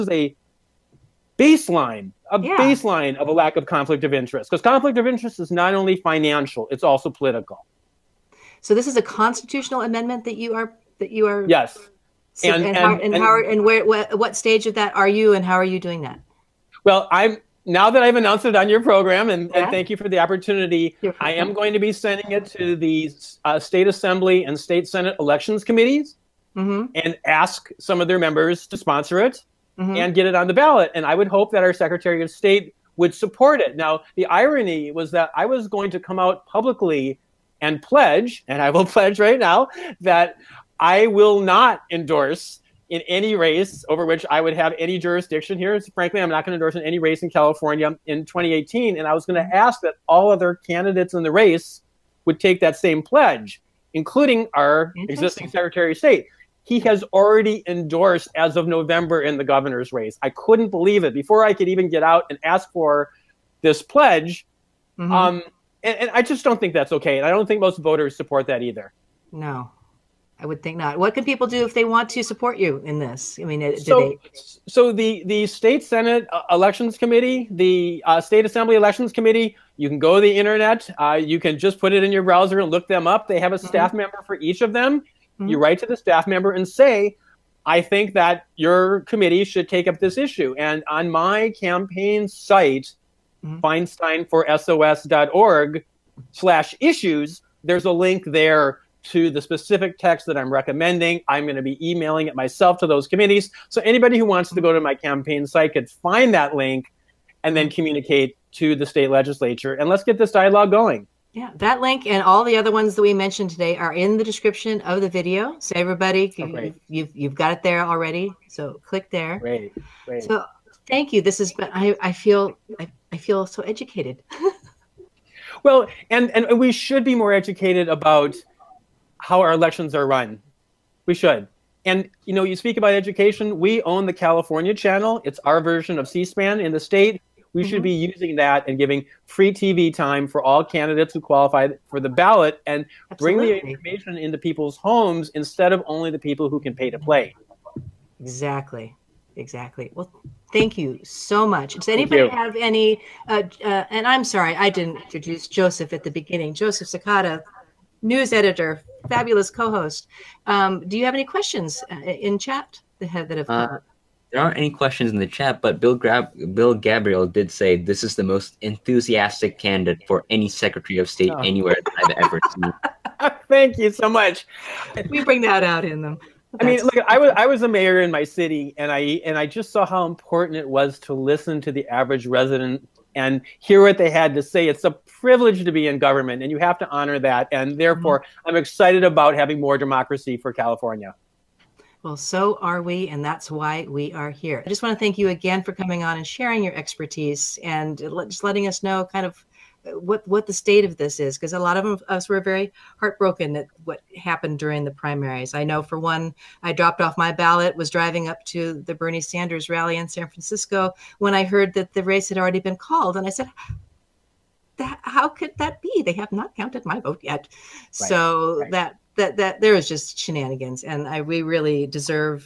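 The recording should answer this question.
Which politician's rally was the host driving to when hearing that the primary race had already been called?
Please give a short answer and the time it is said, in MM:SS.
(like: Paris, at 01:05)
Bernie Sanders, at 03:28.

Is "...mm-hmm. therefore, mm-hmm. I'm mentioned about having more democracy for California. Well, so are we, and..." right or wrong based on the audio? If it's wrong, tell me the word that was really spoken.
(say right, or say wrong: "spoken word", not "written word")
wrong: "excited", not "mentioned".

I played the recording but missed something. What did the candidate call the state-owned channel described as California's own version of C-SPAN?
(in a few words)
The California Channel.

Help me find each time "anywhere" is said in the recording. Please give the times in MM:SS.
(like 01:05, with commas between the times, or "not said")
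02:51.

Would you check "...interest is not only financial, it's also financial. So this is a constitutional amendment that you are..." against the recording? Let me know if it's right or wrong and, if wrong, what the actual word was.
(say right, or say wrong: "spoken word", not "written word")
wrong: "political", not "financial".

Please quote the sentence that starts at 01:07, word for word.
And I don't think most voters support that either.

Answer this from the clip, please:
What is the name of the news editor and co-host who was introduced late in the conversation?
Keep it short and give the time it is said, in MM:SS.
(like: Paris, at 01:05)
Joseph Sakata, at 02:36.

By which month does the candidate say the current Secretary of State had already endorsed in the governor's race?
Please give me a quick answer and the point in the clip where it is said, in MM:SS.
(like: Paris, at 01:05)
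November, at 00:58.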